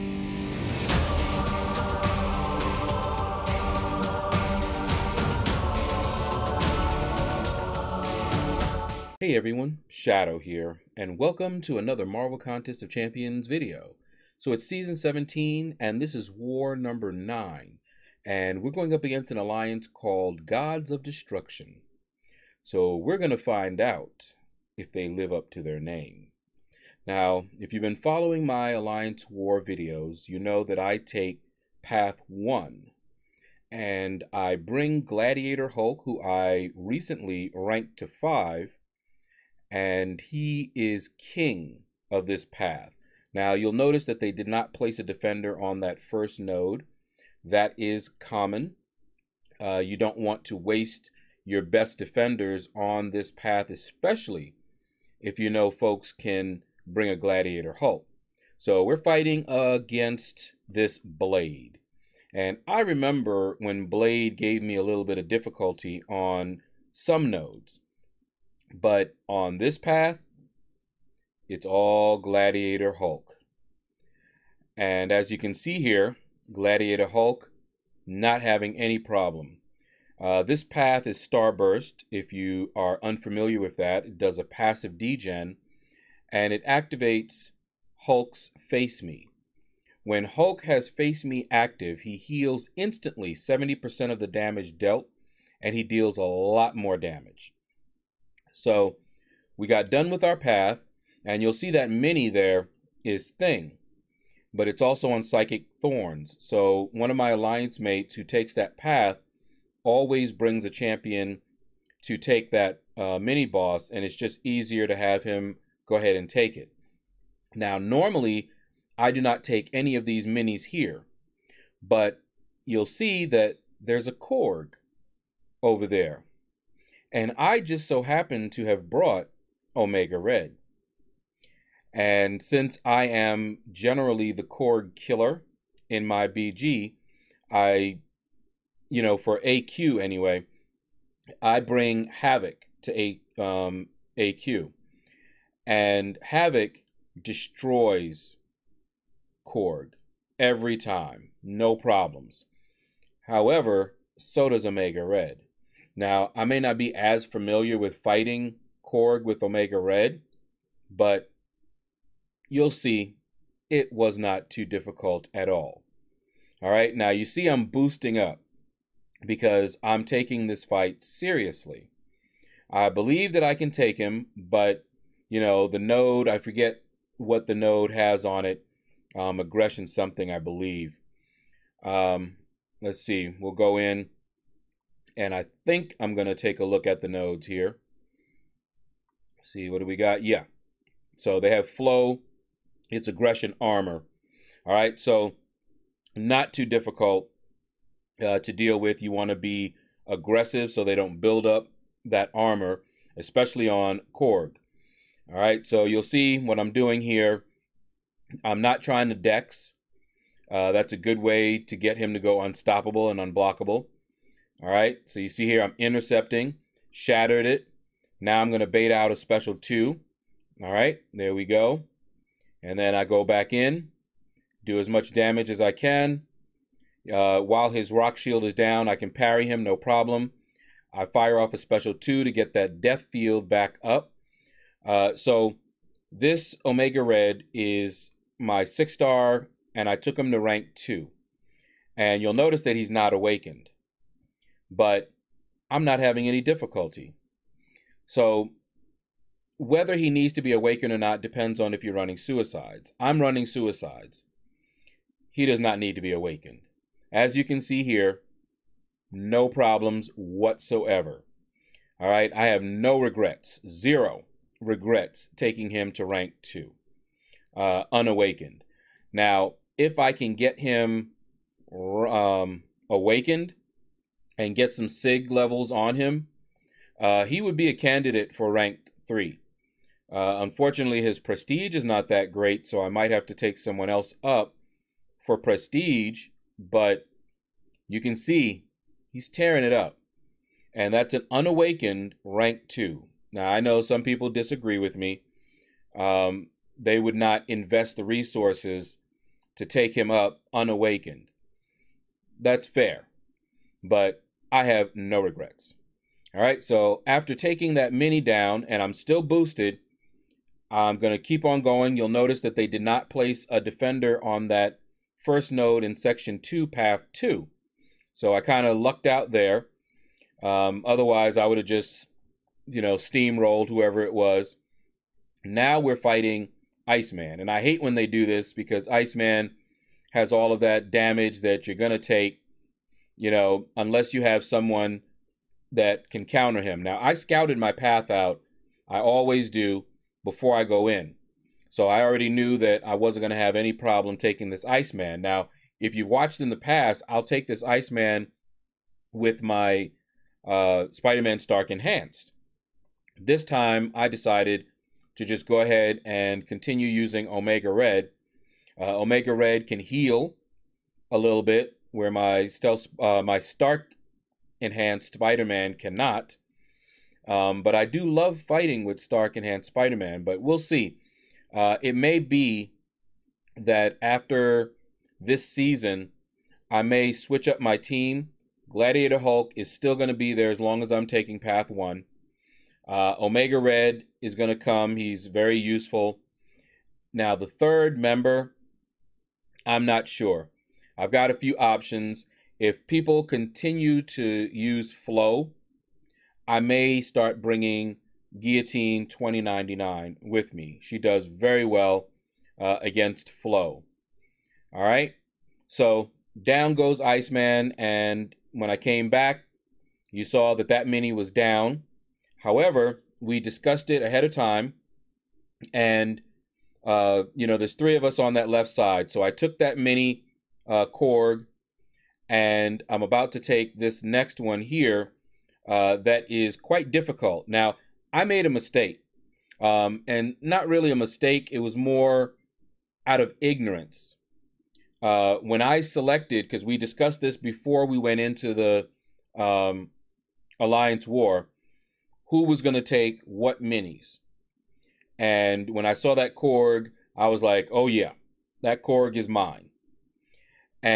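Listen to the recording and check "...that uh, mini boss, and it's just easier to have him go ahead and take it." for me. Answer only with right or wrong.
right.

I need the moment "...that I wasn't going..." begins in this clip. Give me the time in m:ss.
5:42.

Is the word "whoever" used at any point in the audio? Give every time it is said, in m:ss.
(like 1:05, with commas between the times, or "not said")
5:23.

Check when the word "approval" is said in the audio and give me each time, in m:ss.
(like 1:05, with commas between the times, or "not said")
not said.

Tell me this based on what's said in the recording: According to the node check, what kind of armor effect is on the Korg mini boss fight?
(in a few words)
aggression armor.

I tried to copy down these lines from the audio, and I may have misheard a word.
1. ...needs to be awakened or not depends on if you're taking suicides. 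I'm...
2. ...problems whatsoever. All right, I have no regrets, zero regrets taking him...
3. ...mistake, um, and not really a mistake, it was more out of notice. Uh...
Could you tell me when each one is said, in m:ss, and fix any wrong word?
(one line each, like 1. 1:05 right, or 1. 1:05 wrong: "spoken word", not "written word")
1. 4:10 wrong: "running", not "taking"
2. 4:19 right
3. 7:08 wrong: "ignorance", not "notice".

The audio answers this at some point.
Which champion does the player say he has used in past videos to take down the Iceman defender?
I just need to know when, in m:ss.
5:50.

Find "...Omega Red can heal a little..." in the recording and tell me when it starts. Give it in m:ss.
5:58.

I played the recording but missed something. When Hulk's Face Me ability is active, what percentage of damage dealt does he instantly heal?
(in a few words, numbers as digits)
70%.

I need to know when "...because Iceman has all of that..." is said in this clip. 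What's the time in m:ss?
5:28.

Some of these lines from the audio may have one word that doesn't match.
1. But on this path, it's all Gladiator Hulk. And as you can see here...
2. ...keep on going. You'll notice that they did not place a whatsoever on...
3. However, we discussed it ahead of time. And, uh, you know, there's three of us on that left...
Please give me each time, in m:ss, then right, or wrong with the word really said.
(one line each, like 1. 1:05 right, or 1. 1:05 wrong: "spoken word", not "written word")
1. 1:08 right
2. 5:11 wrong: "defender", not "whatsoever"
3. 6:52 right.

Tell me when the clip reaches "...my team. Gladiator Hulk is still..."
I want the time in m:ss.
6:17.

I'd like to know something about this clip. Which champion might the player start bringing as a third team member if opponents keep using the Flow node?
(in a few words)
Guillotine 2099.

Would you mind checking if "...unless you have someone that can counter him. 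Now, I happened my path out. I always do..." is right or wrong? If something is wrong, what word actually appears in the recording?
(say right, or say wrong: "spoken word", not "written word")
wrong: "scouted", not "happened".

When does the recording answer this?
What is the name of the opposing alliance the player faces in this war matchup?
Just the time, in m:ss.
0:20.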